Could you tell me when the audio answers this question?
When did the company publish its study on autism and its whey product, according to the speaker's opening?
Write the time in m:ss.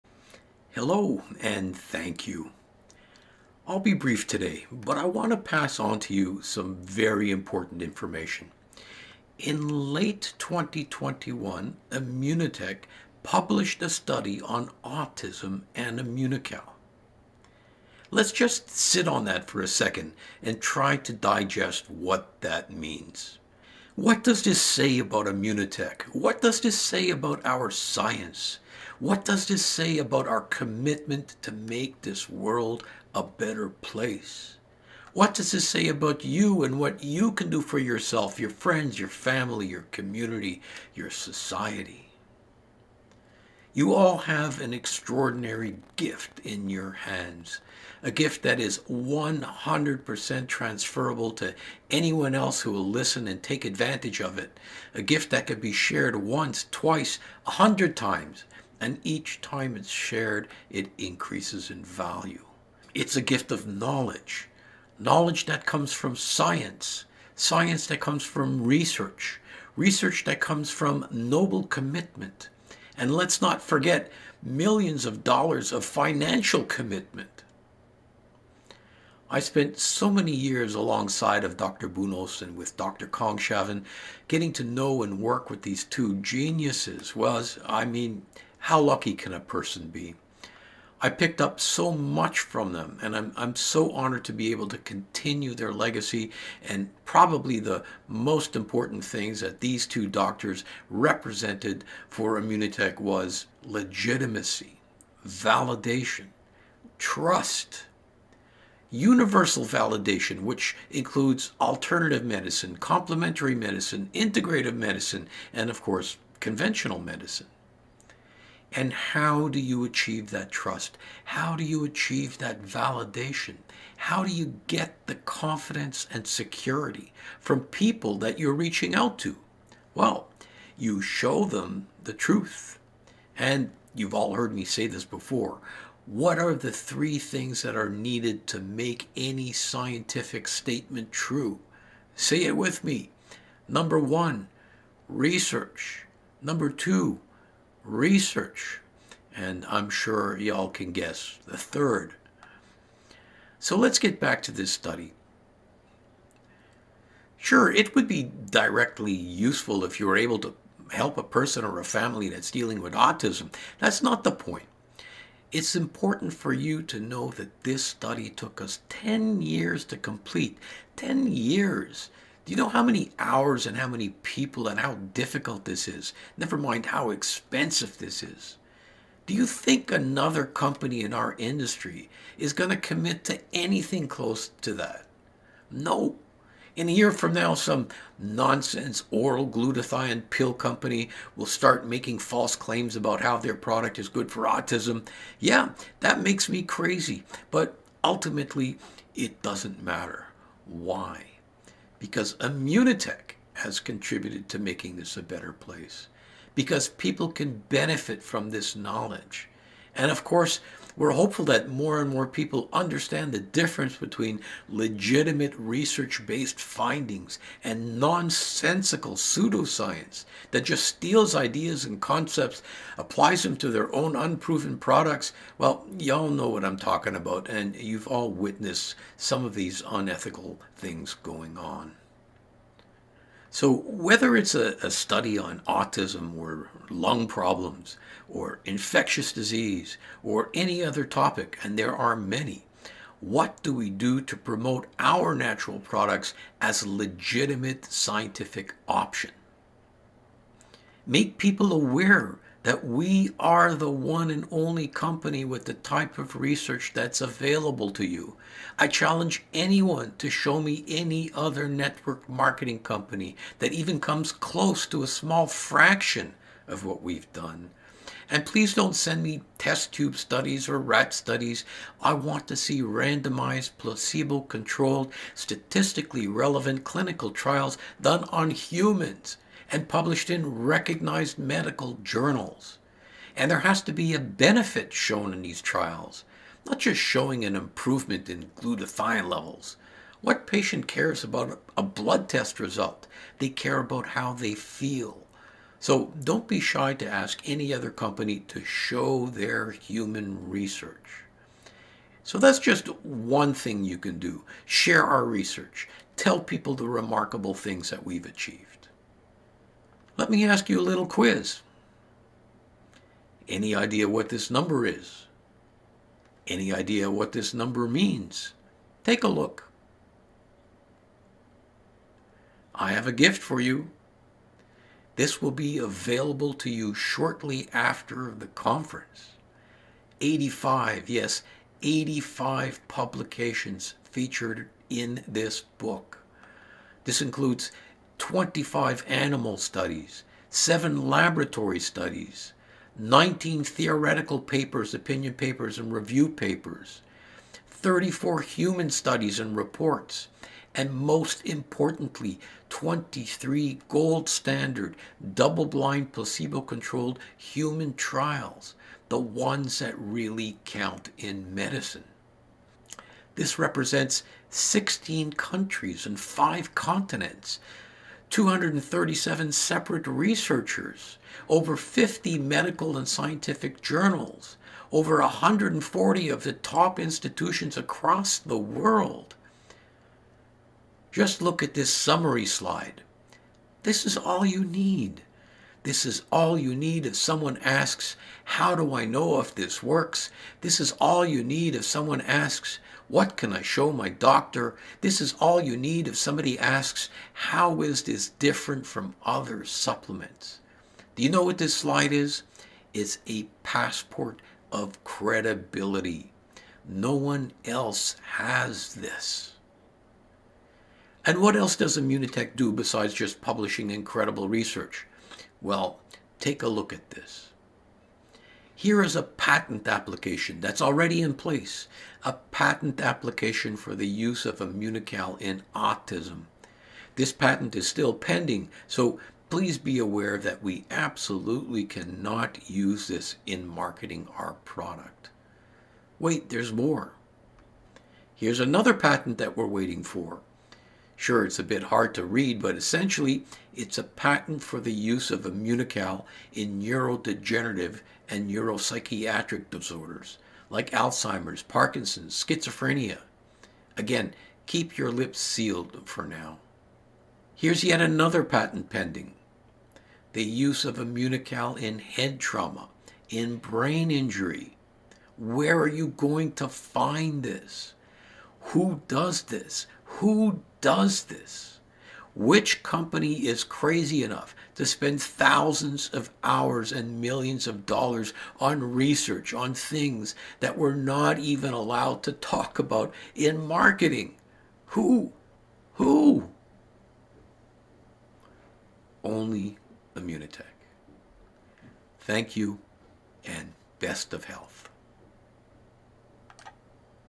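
0:09.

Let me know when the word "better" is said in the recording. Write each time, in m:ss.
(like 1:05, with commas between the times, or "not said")
0:33, 3:25.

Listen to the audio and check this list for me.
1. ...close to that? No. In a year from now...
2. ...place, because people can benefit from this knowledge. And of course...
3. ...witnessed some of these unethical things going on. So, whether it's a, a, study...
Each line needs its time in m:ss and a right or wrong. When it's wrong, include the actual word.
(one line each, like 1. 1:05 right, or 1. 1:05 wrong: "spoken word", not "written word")
1. 3:04 right
2. 3:25 right
3. 3:48 right.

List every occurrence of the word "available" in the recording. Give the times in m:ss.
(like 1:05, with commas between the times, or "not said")
4:17, 5:25.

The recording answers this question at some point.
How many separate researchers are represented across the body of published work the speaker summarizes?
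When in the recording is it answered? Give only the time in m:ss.
6:08.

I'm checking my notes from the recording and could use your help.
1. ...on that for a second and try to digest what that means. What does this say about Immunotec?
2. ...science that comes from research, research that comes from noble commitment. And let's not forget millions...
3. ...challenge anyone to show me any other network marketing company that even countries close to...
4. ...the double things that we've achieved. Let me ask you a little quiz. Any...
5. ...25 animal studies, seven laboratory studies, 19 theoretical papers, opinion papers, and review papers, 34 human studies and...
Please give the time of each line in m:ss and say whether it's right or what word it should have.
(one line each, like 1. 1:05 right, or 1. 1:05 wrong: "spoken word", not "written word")
1. 0:19 right
2. 1:07 right
3. 4:18 wrong: "comes", not "countries"
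4. 5:06 wrong: "remarkable", not "double"
5. 5:38 right.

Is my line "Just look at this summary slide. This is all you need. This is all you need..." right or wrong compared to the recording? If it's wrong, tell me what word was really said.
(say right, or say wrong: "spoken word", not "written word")
right.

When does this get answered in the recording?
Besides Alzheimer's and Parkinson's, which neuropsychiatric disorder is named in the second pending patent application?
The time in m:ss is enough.
7:32.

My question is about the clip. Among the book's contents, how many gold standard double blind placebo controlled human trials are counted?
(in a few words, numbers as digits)
23.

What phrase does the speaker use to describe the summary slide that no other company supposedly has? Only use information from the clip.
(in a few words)
passport of credibility.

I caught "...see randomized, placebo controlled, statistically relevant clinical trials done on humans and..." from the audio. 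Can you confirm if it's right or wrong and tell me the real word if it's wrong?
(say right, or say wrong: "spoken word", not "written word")
right.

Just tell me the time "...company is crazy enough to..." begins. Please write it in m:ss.
7:52.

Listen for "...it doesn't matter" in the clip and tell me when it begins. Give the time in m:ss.
3:19.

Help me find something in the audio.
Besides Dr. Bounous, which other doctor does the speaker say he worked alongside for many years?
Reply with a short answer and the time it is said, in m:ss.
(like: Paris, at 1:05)
Dr. Kongshavn, at 1:22.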